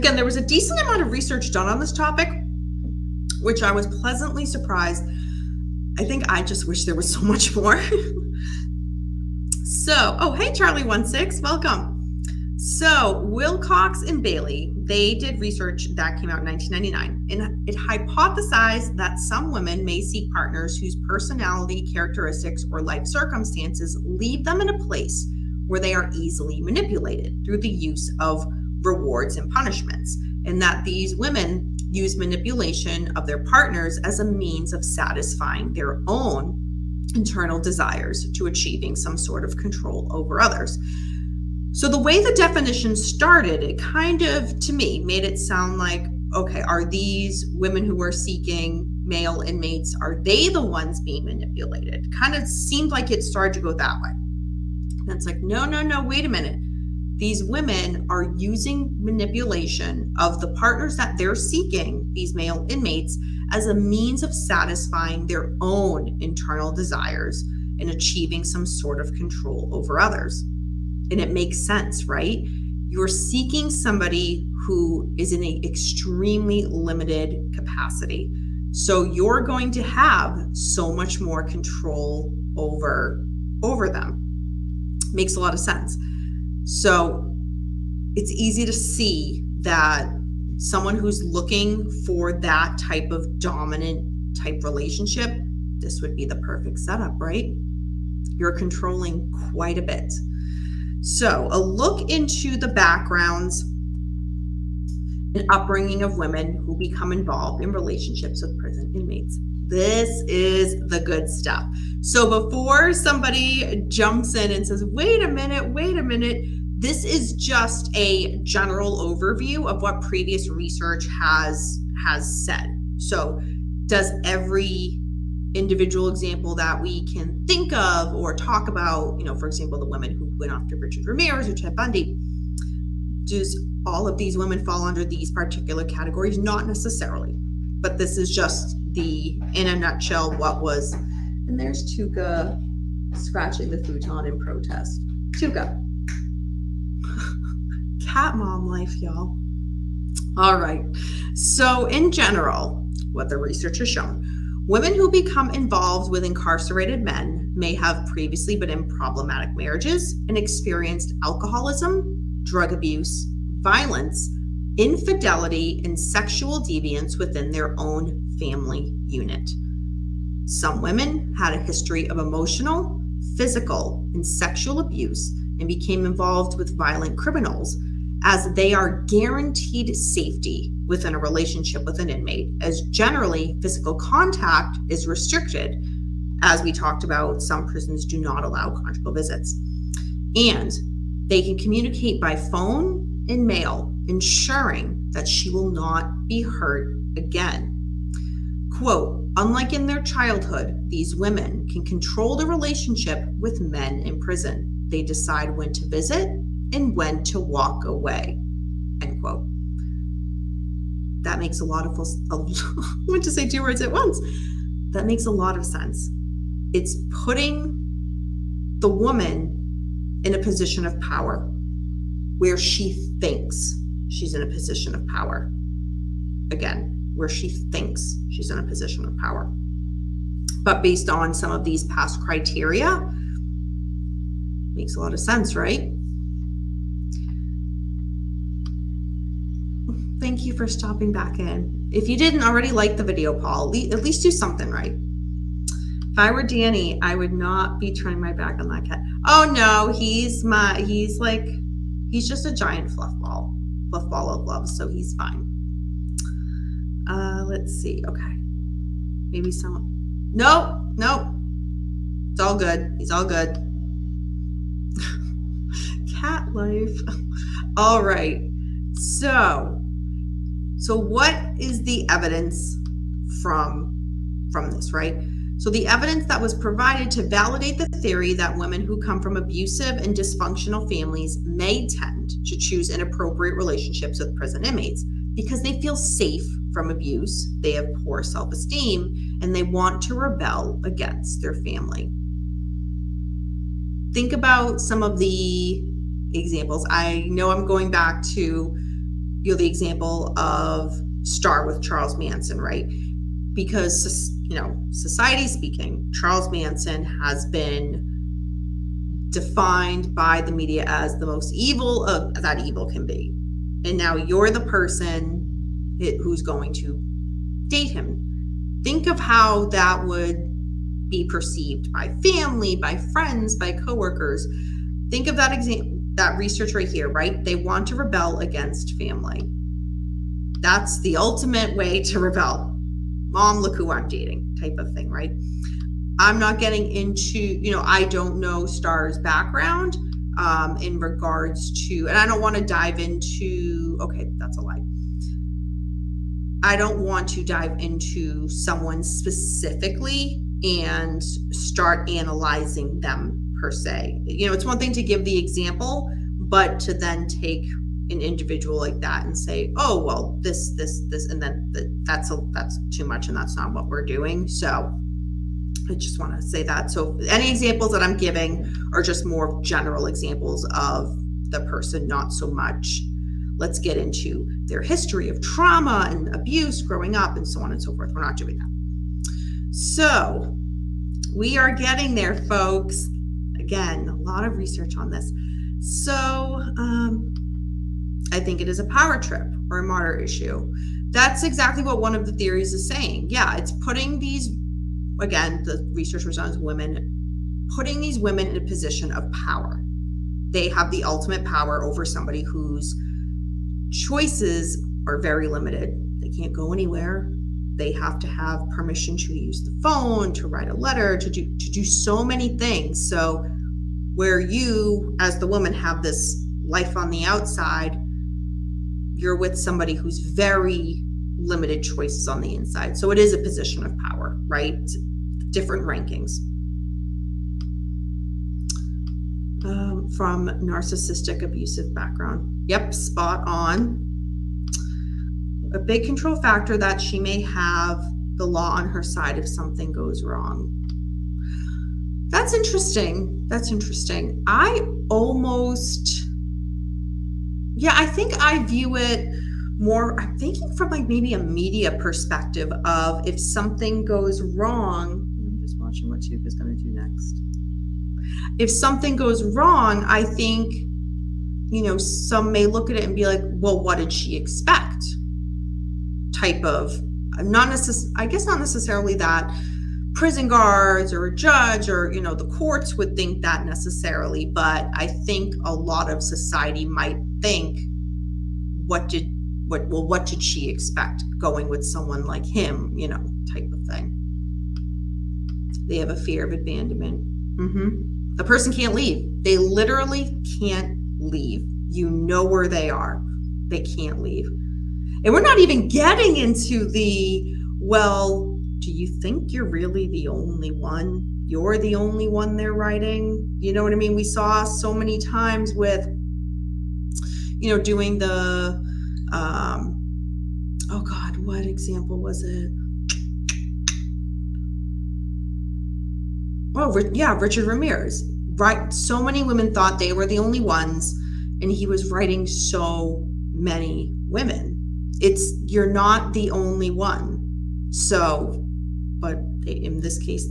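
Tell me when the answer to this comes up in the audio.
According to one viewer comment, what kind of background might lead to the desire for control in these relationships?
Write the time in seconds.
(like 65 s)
430 s.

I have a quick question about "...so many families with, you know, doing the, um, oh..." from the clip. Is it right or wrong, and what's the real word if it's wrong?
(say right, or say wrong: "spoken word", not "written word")
wrong: "times", not "families".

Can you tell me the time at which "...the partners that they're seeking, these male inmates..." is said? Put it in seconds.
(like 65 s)
60 s.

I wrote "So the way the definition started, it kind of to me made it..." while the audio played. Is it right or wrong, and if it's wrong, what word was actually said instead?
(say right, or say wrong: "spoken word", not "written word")
right.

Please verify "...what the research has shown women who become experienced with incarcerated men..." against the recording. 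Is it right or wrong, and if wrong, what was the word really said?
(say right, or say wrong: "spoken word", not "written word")
wrong: "involved", not "experienced".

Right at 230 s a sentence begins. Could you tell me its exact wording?
But based on some of these past criteria, makes a lot of sense, right?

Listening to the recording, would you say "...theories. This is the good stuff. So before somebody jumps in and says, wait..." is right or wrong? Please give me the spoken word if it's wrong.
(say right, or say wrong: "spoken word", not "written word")
wrong: "inmates", not "theories".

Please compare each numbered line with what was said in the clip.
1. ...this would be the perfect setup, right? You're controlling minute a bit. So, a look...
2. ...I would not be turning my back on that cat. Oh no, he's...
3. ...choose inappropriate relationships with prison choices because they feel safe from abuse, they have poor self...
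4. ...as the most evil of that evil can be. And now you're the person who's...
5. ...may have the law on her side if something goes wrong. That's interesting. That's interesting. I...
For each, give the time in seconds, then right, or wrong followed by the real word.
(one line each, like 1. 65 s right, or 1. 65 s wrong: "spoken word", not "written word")
1. 95 s wrong: "quite", not "minute"
2. 247 s right
3. 282 s wrong: "inmates", not "choices"
4. 310 s right
5. 437 s right.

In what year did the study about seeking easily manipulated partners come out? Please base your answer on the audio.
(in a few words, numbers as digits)
1999.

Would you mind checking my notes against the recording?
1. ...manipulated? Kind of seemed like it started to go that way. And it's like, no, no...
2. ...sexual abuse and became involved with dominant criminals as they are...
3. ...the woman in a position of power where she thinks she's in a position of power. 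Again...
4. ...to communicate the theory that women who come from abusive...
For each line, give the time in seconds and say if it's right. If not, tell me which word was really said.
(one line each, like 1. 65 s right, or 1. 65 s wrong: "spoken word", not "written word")
1. 51 s right
2. 174 s wrong: "violent", not "dominant"
3. 218 s right
4. 277 s wrong: "validate", not "communicate".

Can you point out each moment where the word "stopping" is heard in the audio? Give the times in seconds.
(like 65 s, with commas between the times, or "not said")
240 s.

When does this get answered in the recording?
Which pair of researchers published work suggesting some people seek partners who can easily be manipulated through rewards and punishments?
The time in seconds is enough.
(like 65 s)
13 s.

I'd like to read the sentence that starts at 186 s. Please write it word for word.
As we talked about, some prisons do not allow conjugal visits.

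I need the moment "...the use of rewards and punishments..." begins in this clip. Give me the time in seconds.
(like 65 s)
27 s.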